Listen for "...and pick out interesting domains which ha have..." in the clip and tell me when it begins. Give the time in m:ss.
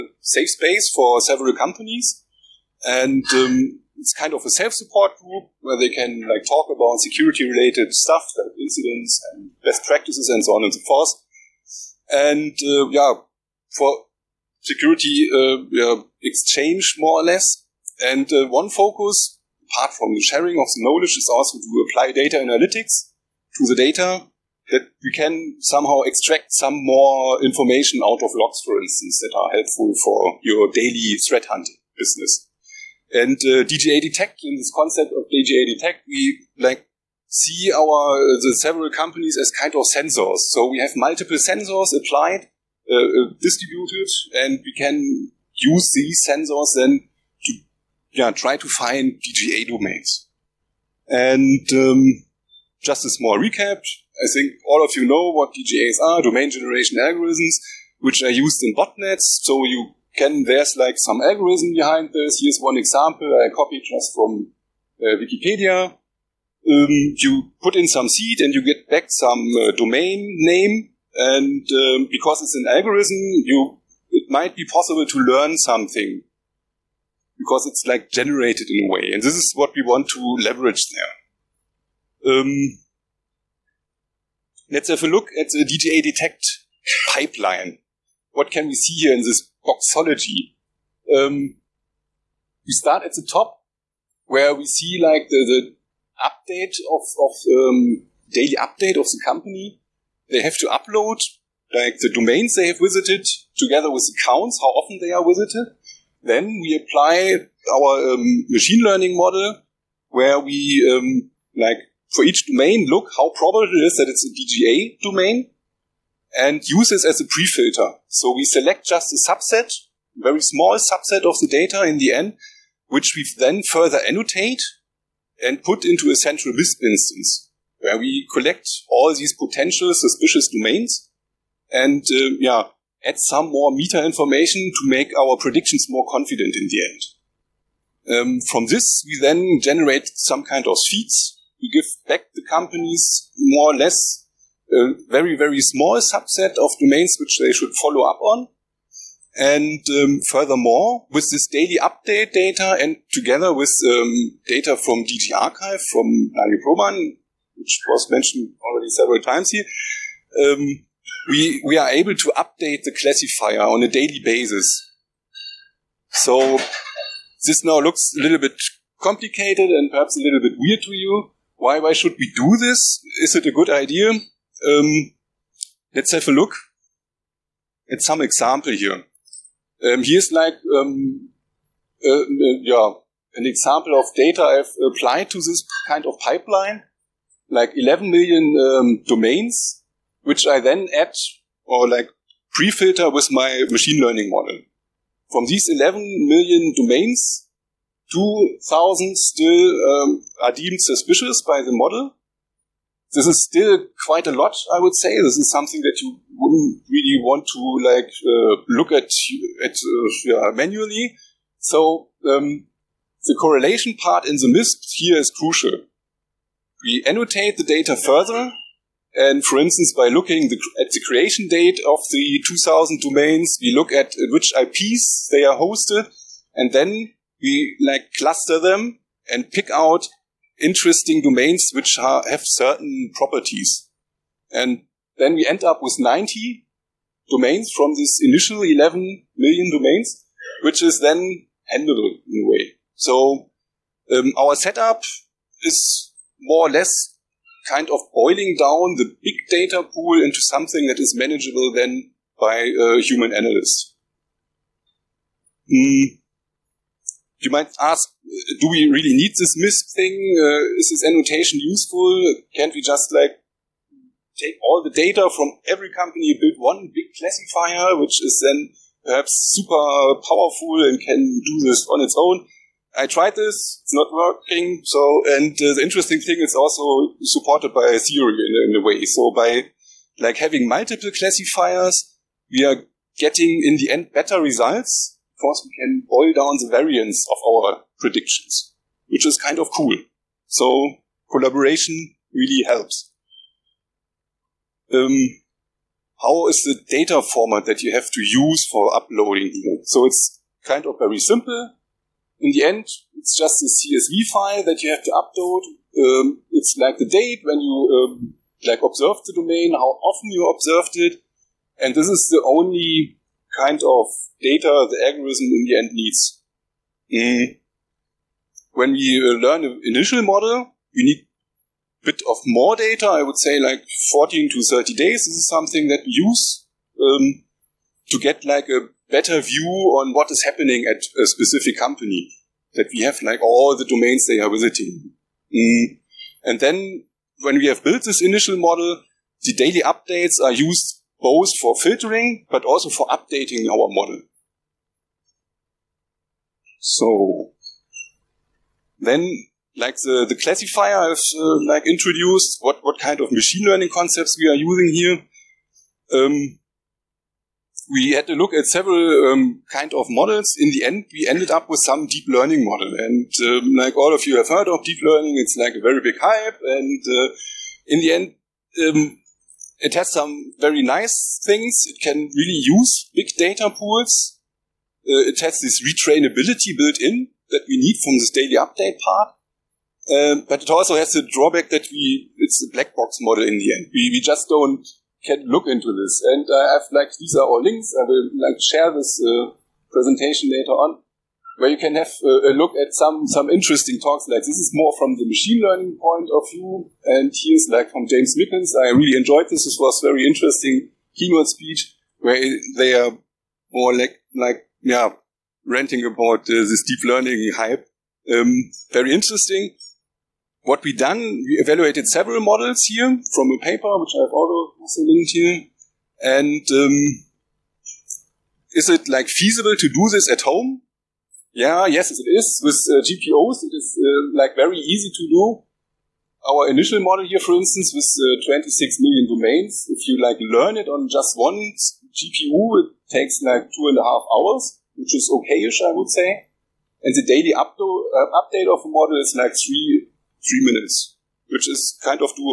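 3:49.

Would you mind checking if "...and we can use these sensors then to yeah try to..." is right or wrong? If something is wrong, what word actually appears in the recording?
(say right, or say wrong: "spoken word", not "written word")
right.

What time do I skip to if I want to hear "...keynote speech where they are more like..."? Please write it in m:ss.
6:41.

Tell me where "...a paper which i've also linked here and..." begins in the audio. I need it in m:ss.
6:53.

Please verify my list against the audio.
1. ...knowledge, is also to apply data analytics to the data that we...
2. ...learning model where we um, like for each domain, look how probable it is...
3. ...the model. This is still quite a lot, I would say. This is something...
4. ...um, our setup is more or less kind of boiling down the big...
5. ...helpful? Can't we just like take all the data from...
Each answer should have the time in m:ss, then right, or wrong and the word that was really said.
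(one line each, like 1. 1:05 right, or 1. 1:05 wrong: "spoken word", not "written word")
1. 0:20 right
2. 1:48 right
3. 3:21 right
4. 4:04 right
5. 4:21 wrong: "useful", not "helpful".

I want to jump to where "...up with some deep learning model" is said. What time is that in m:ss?
6:01.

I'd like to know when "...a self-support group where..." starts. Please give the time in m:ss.
0:04.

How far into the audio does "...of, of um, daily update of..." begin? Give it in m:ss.
1:36.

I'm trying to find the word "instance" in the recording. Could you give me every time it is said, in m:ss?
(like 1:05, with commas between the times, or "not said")
0:28, 2:06, 3:39, 7:07.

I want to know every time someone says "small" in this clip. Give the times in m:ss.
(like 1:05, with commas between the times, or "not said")
0:53, 2:00, 2:25.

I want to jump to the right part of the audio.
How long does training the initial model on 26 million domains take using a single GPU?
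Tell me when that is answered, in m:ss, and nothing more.
7:13.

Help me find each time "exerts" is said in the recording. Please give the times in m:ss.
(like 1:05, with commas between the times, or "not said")
not said.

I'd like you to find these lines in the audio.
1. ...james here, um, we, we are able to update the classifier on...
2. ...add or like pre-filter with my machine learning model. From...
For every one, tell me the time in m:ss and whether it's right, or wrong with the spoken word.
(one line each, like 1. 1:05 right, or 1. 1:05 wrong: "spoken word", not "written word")
1. 2:39 wrong: "times", not "james"
2. 3:10 right.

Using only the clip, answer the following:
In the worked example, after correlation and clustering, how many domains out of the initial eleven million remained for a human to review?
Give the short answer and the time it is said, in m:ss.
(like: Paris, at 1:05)
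90, at 3:55.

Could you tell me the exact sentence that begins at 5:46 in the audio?
So then, like the, the classifier is uh, like introduced, what, what kind of machine learning concepts we are using here.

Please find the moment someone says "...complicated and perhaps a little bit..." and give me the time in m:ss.
2:49.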